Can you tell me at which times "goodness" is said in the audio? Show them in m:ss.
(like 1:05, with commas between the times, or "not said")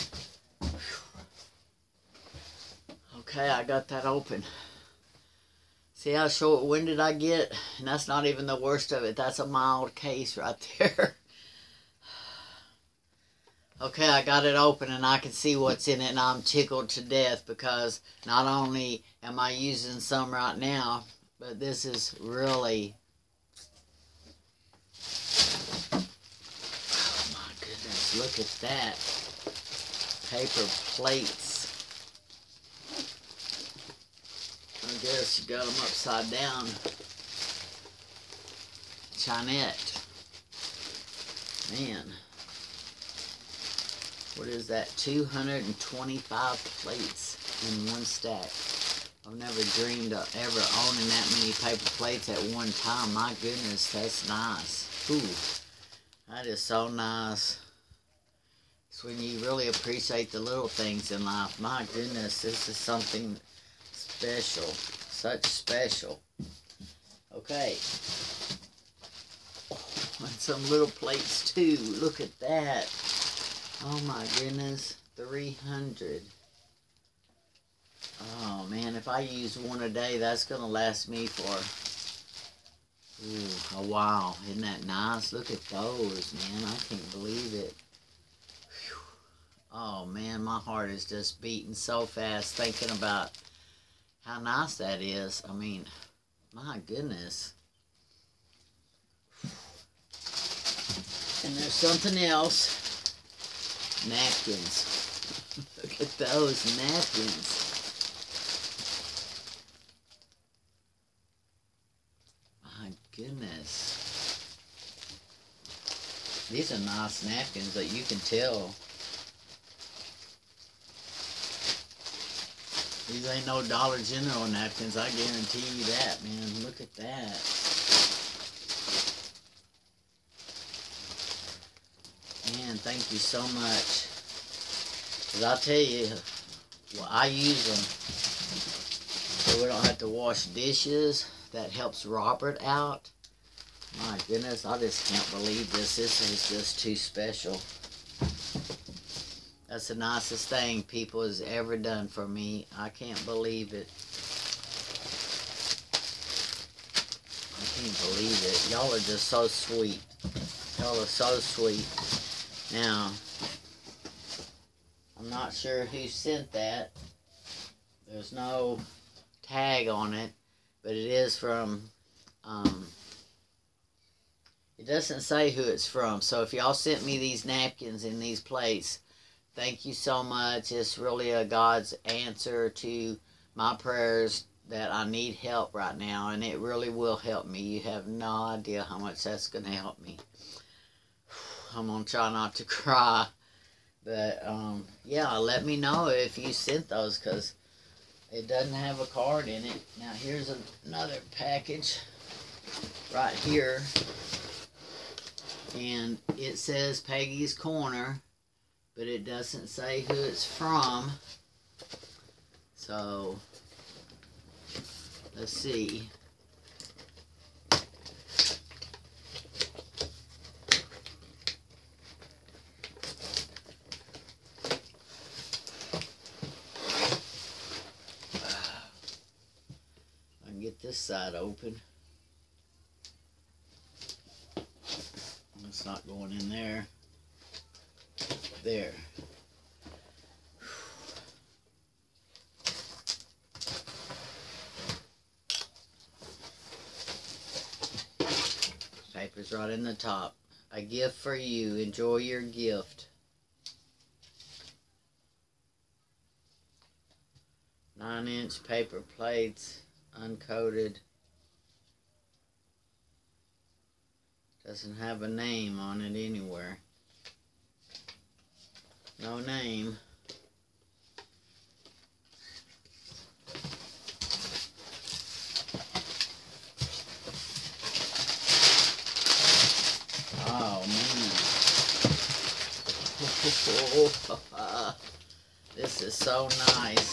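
0:27, 0:53, 1:01, 1:14, 1:36, 1:53, 2:24.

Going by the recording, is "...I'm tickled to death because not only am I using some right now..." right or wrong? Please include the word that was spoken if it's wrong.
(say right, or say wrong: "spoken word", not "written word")
right.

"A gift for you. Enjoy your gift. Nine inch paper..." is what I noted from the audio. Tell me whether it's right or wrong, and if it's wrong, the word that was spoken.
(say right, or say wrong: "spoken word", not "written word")
right.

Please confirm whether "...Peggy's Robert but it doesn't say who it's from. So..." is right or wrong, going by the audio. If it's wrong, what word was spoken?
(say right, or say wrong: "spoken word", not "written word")
wrong: "Corner", not "Robert".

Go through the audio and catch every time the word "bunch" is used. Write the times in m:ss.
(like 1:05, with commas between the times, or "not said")
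not said.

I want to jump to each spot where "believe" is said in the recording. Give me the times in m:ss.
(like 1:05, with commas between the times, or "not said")
1:27, 2:25, 2:33, 2:38.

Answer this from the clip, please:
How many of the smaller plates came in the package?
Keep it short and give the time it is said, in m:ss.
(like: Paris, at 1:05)
300, at 1:15.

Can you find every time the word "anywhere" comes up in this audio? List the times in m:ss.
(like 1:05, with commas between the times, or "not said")
4:26.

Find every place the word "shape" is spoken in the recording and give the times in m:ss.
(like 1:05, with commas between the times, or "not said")
not said.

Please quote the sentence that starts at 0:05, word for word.
See how short winded I get?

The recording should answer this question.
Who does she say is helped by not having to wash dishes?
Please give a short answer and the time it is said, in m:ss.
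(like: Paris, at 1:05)
Robert, at 2:22.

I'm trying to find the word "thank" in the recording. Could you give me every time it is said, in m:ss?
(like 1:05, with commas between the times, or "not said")
2:12, 2:59.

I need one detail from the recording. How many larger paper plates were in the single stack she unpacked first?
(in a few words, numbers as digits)
225.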